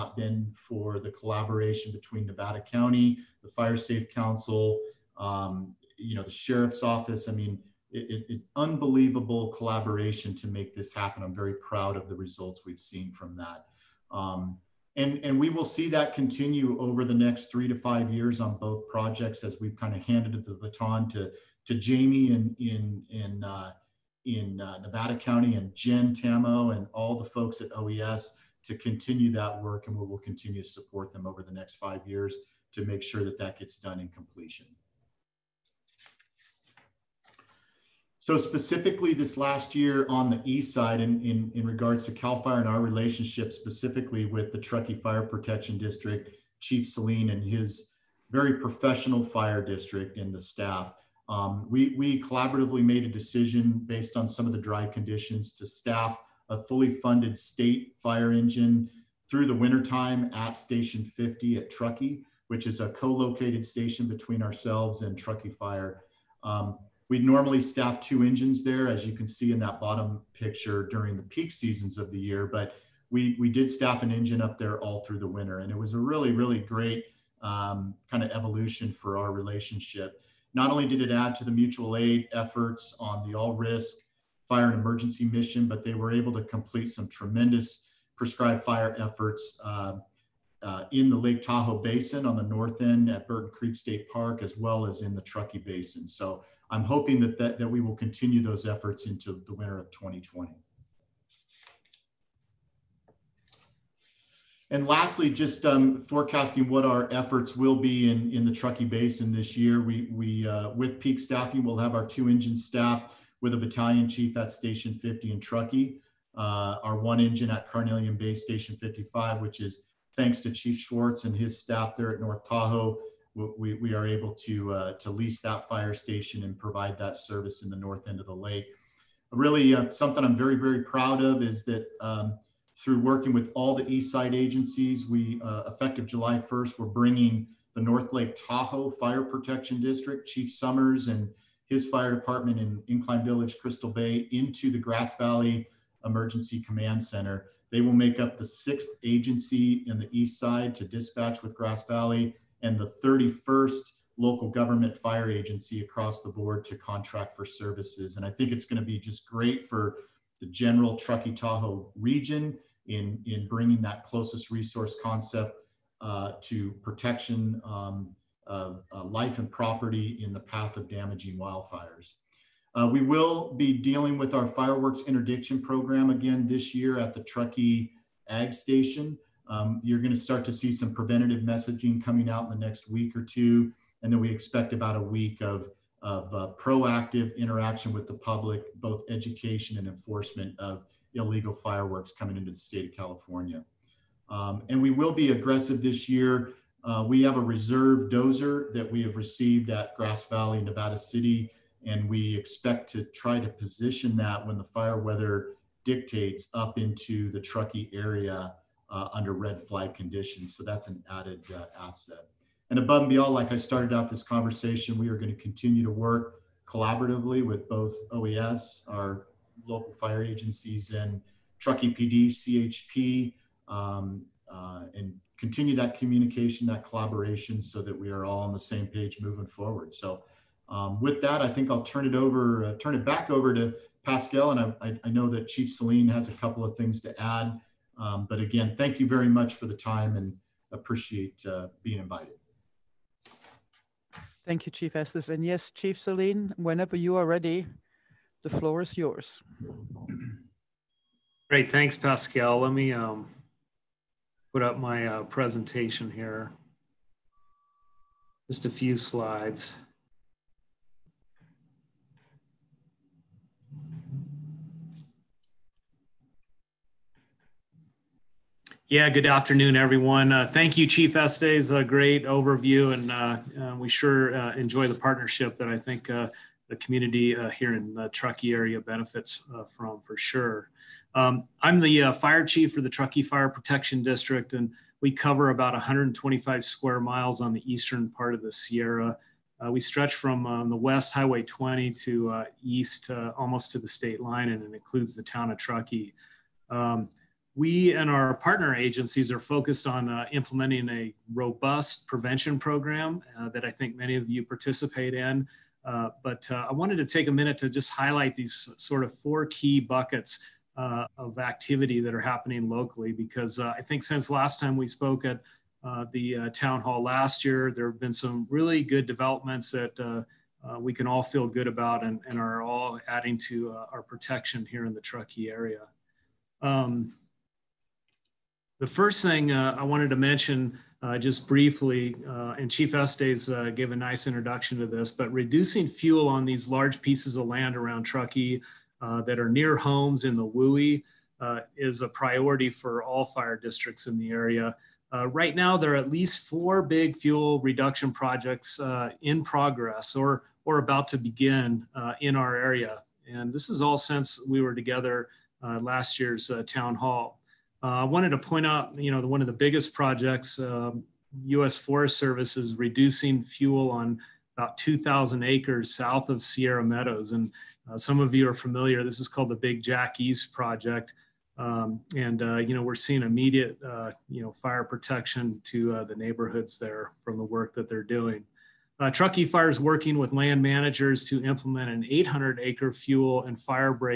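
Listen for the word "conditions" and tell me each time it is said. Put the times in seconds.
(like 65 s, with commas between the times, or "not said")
54 s, 209 s.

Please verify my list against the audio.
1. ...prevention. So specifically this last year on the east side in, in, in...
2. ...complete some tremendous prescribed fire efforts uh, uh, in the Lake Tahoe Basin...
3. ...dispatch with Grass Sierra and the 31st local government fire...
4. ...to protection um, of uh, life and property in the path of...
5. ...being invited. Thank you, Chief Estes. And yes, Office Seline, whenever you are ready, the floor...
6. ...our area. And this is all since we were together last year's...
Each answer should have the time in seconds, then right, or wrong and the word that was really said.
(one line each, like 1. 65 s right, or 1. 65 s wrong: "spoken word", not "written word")
1. 34 s wrong: "completion", not "prevention"
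2. 86 s right
3. 150 s wrong: "Valley", not "Sierra"
4. 166 s right
5. 241 s wrong: "Chief", not "Office"
6. 352 s right.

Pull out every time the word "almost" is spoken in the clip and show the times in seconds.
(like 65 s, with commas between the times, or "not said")
293 s.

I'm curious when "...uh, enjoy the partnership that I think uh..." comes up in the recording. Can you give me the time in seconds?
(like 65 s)
274 s.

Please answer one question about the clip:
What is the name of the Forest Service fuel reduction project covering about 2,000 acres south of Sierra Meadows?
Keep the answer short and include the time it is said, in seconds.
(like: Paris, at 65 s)
Big Jack East Project, at 369 s.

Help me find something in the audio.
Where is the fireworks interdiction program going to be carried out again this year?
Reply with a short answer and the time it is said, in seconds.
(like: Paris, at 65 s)
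Truckee Ag Station, at 177 s.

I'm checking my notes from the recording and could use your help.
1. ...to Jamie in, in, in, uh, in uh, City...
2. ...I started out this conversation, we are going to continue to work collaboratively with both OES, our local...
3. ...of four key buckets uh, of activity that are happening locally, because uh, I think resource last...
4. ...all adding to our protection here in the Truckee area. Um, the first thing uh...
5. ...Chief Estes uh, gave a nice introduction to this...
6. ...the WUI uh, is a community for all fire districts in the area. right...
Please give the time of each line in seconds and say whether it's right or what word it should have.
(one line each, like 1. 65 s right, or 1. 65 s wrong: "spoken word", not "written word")
1. 21 s wrong: "Nevada", not "City"
2. 213 s right
3. 309 s wrong: "since", not "resource"
4. 322 s right
5. 332 s right
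6. 340 s wrong: "priority", not "community".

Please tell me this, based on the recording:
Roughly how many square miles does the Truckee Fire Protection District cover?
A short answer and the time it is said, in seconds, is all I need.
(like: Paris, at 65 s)
125, at 285 s.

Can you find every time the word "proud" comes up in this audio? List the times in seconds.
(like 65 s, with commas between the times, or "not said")
11 s, 130 s.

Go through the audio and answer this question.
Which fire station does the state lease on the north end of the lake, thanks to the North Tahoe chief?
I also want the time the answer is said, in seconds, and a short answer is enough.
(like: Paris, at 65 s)
Carnelian Bay Station 55, at 117 s.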